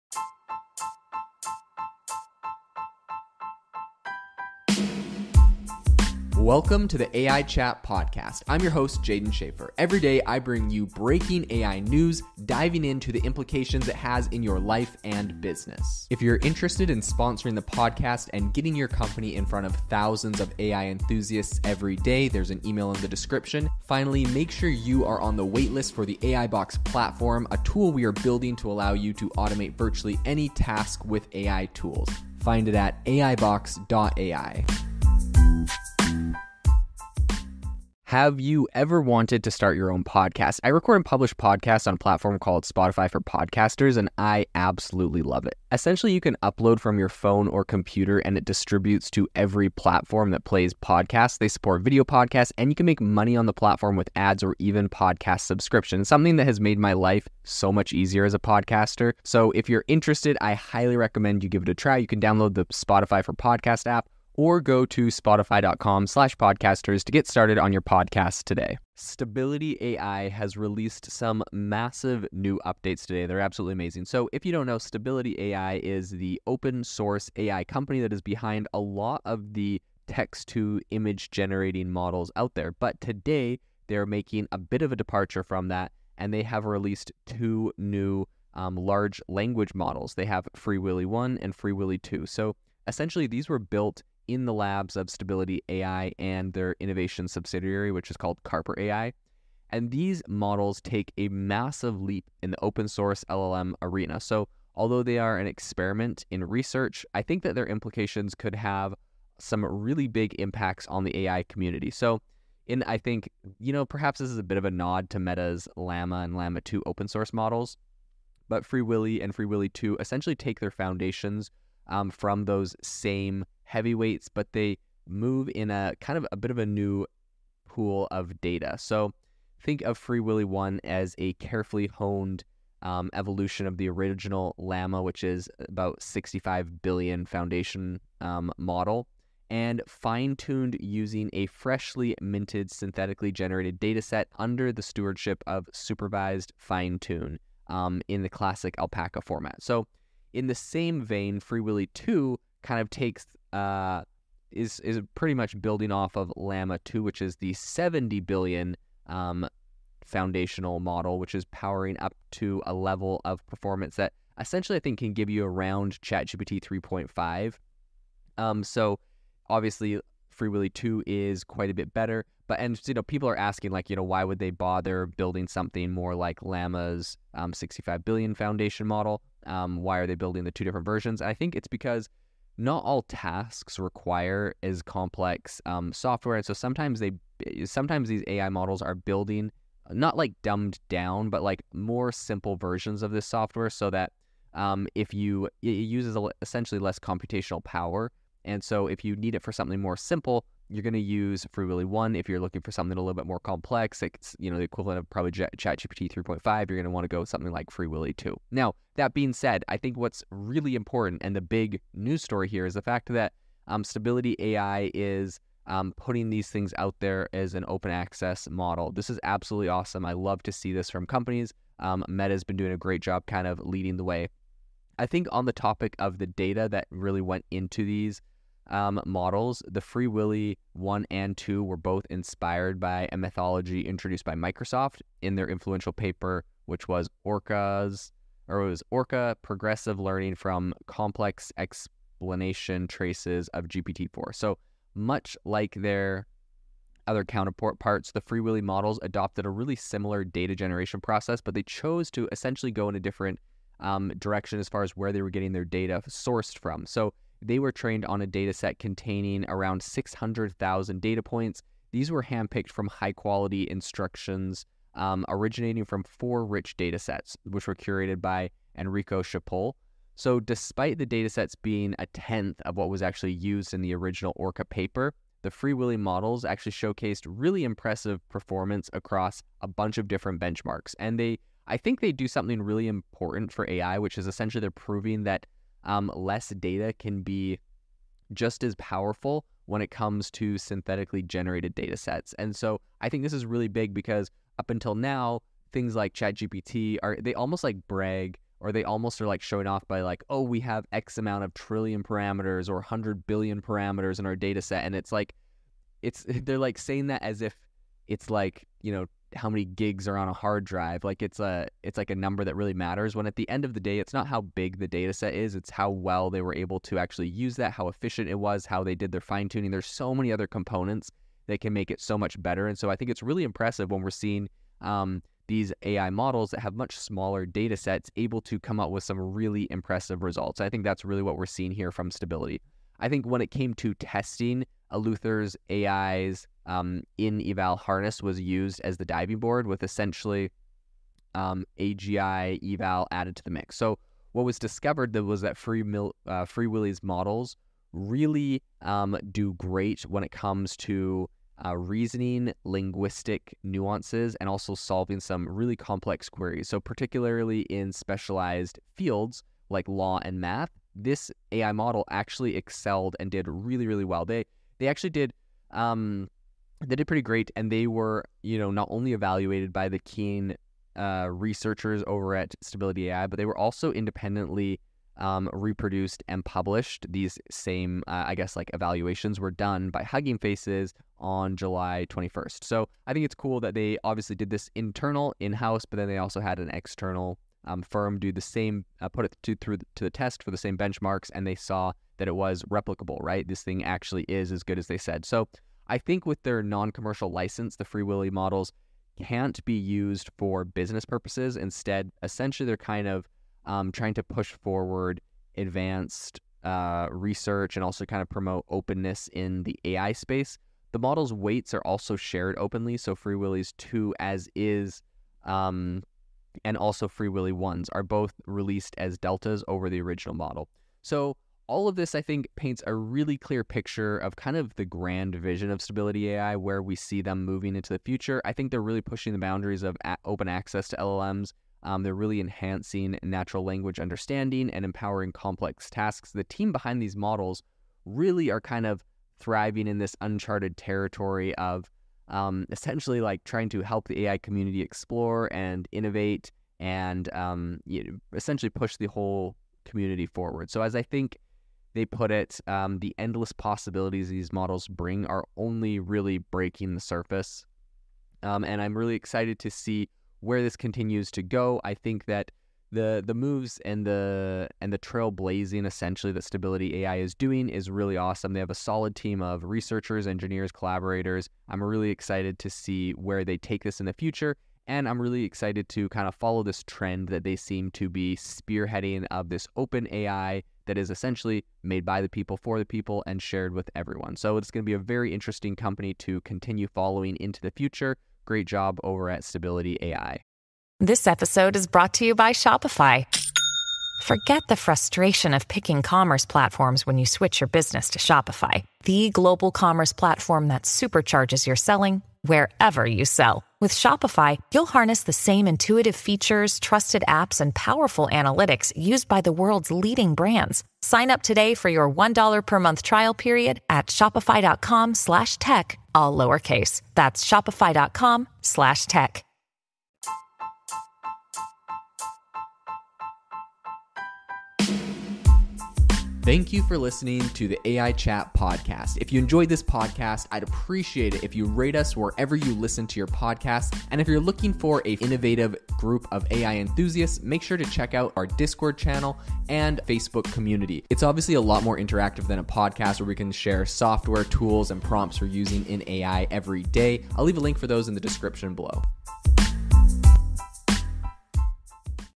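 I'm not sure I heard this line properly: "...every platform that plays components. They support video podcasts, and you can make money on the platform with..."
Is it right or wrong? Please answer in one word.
wrong.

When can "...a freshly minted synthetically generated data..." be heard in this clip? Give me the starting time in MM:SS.
02:21.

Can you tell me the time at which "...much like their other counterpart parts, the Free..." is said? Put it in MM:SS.
04:04.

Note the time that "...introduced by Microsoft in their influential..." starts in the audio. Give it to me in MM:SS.
03:53.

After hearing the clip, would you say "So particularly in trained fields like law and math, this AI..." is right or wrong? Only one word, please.
wrong.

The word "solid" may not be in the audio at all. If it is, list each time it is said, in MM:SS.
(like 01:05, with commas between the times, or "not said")
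07:48.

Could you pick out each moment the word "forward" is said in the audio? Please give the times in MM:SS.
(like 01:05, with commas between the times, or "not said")
06:44, 07:30.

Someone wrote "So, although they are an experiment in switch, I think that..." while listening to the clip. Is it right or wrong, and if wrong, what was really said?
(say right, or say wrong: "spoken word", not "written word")
wrong: "research", not "switch".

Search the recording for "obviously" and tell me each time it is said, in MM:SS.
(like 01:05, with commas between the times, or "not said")
02:49, 06:24, 09:01.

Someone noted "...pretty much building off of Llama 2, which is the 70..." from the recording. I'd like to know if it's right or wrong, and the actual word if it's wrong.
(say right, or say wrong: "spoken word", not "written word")
right.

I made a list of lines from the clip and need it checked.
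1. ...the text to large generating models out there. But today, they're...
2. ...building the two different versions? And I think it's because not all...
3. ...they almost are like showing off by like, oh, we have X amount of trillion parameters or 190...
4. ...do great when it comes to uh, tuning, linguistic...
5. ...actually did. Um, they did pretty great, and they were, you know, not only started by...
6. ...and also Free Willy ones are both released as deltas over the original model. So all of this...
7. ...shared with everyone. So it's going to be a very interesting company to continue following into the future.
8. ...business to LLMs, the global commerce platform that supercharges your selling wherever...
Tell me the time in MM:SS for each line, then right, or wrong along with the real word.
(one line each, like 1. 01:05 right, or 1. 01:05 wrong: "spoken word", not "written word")
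1. 01:19 wrong: "image", not "large"
2. 03:00 right
3. 04:58 wrong: "100", not "190"
4. 05:49 wrong: "reasoning", not "tuning"
5. 06:04 wrong: "evaluated", not "started"
6. 06:56 right
7. 08:03 right
8. 08:17 wrong: "Shopify", not "LLMs".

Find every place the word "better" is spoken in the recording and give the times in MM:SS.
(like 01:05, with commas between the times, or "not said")
02:51, 05:22.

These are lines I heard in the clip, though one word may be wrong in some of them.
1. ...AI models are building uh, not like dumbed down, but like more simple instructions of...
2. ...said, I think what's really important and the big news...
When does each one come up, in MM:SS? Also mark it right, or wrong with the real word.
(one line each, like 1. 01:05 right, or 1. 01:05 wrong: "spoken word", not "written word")
1. 03:08 wrong: "versions", not "instructions"
2. 03:29 right.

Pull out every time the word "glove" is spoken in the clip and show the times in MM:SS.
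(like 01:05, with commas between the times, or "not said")
not said.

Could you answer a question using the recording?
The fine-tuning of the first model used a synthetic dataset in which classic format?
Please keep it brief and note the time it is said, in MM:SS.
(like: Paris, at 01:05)
Alpaca, at 02:28.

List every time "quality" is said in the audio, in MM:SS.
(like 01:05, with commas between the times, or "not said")
04:23.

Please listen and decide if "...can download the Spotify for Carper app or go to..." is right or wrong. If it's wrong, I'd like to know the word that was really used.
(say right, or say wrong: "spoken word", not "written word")
wrong: "Podcast", not "Carper".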